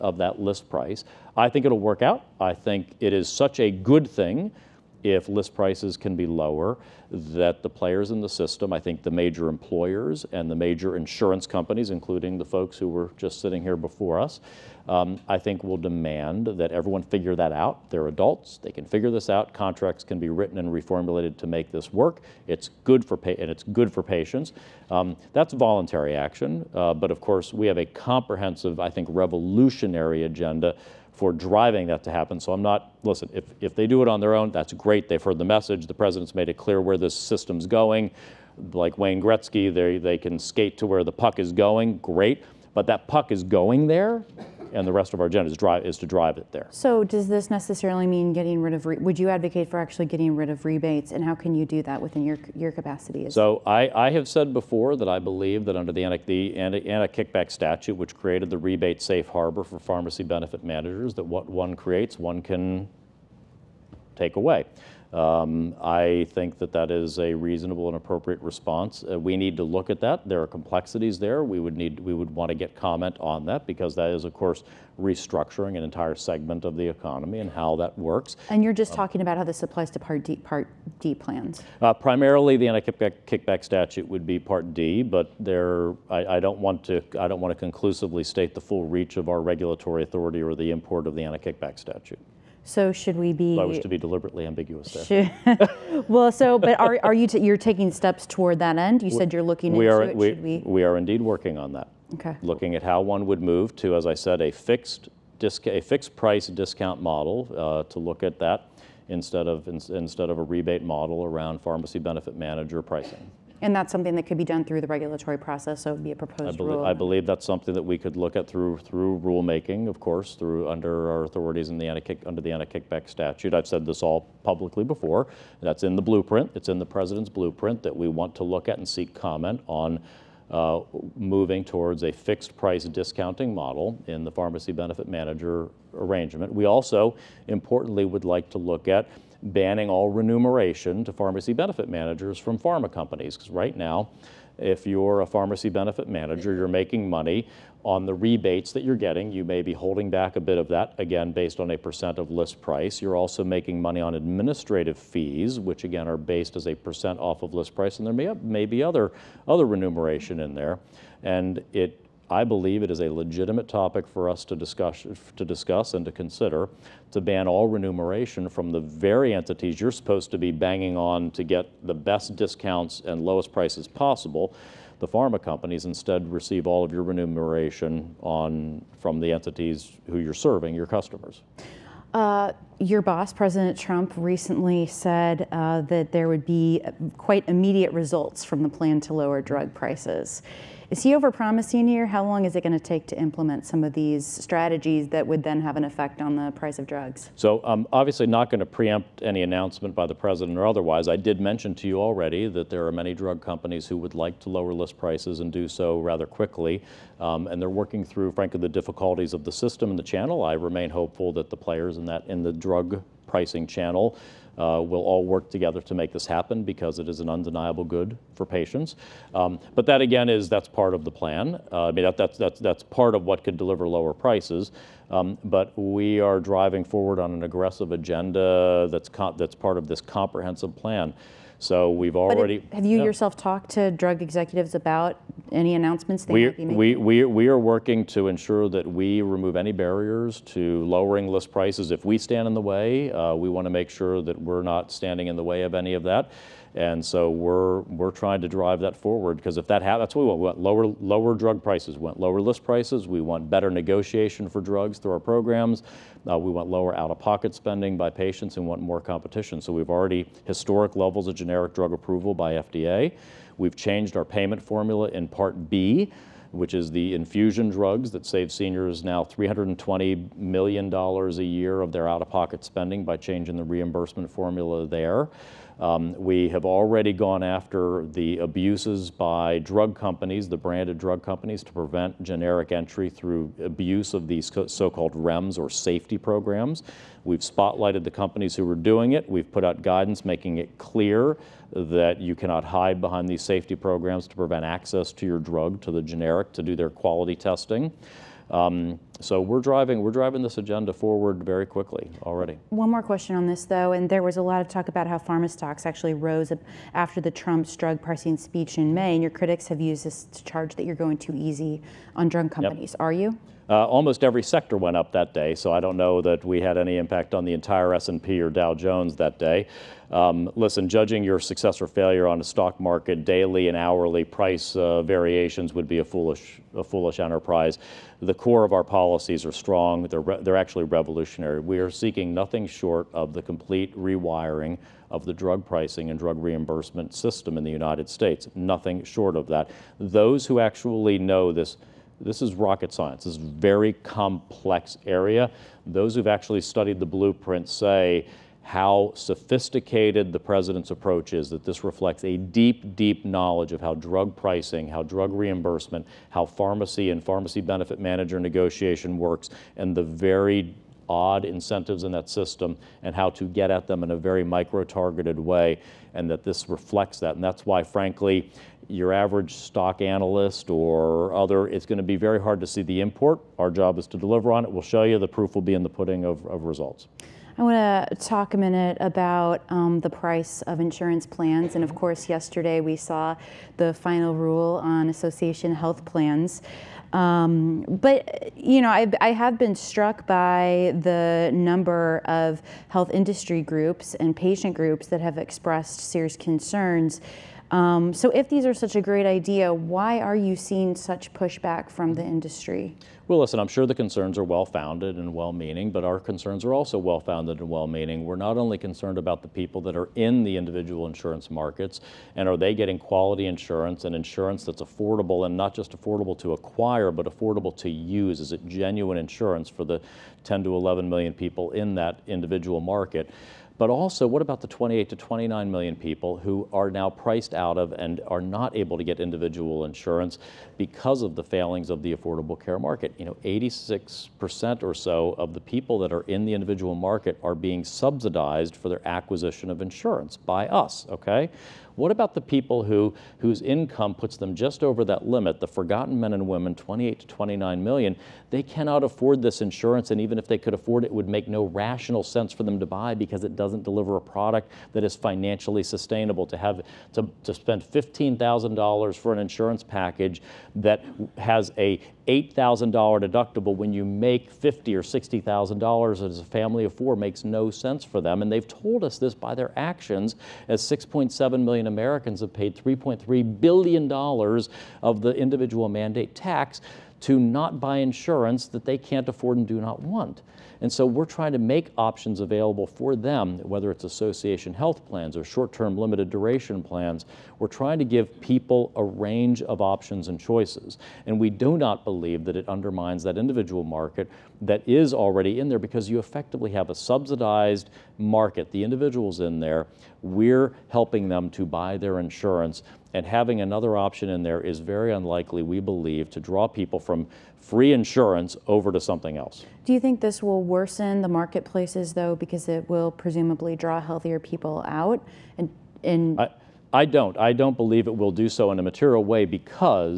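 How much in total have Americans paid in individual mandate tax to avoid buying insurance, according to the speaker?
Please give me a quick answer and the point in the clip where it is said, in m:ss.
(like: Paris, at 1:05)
$3.3 billion, at 7:52.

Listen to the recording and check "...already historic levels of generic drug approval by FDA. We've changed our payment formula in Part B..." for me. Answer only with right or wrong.
right.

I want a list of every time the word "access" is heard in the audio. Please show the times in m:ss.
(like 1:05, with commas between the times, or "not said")
4:54.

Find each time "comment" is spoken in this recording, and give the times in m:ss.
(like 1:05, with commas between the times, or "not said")
1:12, 2:09.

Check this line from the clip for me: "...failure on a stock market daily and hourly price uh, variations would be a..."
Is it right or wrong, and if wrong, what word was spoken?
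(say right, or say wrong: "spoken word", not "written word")
right.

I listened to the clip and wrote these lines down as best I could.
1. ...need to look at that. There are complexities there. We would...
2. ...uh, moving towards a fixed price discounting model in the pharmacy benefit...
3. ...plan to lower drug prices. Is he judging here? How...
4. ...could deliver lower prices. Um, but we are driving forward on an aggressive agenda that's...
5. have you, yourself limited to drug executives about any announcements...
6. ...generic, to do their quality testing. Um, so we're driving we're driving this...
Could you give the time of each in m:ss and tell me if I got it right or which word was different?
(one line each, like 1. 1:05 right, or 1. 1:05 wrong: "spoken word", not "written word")
1. 1:09 right
2. 2:10 right
3. 3:08 wrong: "overpromising", not "judging"
4. 3:43 right
5. 3:52 wrong: "talked", not "limited"
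6. 4:56 right.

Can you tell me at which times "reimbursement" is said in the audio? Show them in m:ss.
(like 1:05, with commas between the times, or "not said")
4:33, 5:36, 5:55.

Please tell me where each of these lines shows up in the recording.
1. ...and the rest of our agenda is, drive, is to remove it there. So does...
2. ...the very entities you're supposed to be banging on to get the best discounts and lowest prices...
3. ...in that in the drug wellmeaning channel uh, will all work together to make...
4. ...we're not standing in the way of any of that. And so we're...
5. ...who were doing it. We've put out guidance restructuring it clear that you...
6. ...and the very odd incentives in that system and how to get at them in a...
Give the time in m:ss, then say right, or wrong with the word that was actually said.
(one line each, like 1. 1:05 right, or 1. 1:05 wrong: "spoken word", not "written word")
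1. 0:44 wrong: "drive", not "remove"
2. 2:48 right
3. 3:31 wrong: "pricing", not "wellmeaning"
4. 4:04 right
5. 4:48 wrong: "making", not "restructuring"
6. 5:59 right.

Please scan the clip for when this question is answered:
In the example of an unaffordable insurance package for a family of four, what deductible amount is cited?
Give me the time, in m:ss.
7:42.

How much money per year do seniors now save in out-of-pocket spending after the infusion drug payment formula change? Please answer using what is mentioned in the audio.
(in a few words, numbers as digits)
$320 million.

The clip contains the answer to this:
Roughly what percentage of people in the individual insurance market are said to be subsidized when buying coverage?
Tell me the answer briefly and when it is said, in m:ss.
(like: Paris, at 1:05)
86%, at 7:13.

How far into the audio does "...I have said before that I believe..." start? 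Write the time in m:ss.
0:53.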